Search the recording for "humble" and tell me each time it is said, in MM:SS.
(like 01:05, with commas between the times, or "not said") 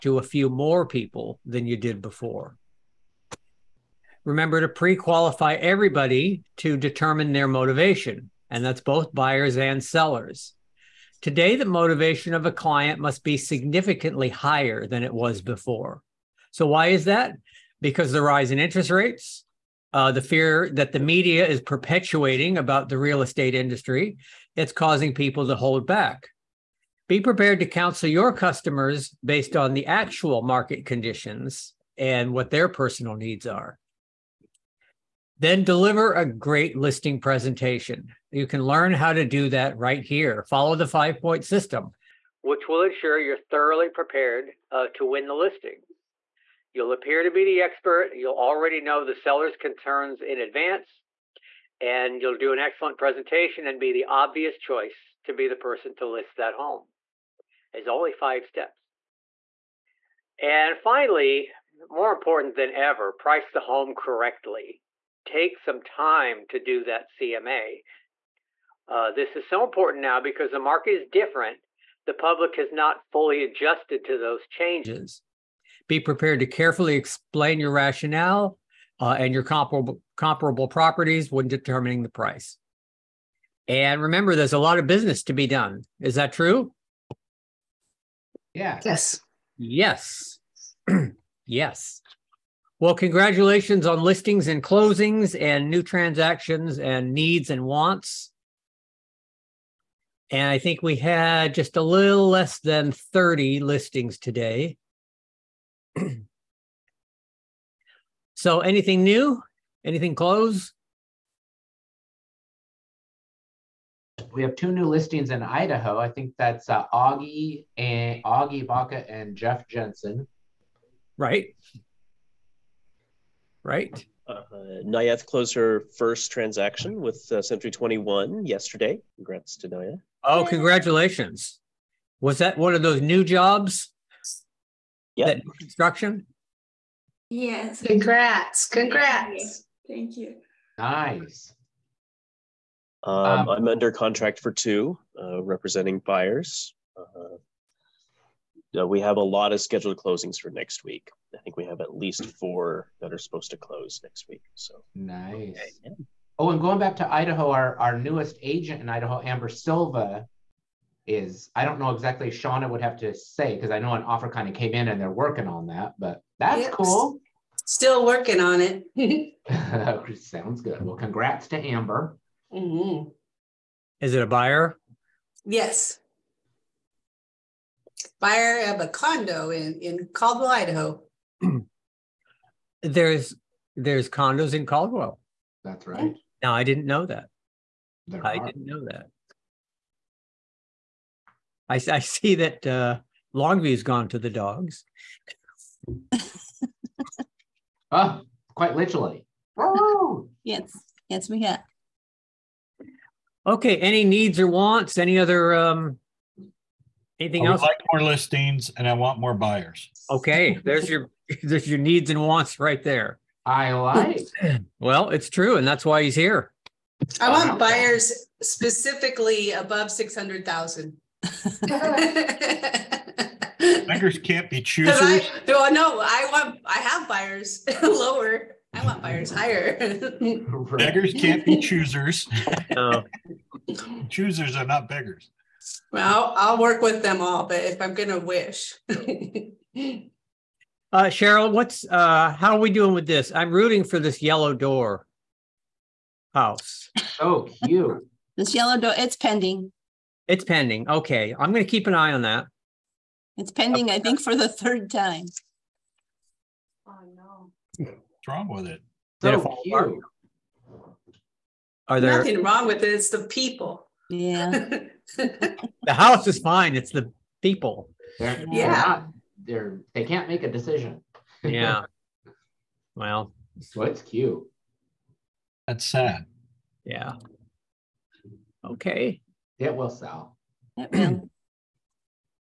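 not said.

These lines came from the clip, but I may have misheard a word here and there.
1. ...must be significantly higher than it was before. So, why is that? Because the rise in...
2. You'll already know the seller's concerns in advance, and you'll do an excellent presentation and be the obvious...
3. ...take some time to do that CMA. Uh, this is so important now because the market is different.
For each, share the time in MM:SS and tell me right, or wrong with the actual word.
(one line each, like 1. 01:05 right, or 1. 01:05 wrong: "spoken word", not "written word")
1. 00:13 right
2. 00:48 right
3. 01:05 right.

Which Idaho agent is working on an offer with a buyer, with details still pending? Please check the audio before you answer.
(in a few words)
Amber Silva.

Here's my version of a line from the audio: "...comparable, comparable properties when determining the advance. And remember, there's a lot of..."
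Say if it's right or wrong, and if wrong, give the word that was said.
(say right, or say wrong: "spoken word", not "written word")
wrong: "price", not "advance".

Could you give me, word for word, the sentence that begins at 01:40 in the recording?
And I think we had just a little less than 30 listings today.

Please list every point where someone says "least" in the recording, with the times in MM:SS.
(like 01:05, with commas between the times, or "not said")
02:31.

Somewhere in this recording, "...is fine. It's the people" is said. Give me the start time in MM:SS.
04:26.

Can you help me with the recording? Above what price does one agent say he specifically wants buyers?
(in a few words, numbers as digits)
600,000.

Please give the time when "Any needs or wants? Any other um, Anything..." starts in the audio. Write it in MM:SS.
03:23.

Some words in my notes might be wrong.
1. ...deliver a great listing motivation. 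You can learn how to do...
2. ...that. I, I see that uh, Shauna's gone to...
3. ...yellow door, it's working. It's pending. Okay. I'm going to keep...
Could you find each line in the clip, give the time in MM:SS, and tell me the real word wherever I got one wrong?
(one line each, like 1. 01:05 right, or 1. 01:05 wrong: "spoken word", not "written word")
1. 00:35 wrong: "presentation", not "motivation"
2. 03:08 wrong: "Longview", not "Shauna"
3. 04:08 wrong: "pending", not "working".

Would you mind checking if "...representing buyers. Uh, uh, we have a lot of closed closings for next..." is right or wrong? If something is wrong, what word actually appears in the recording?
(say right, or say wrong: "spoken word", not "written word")
wrong: "scheduled", not "closed".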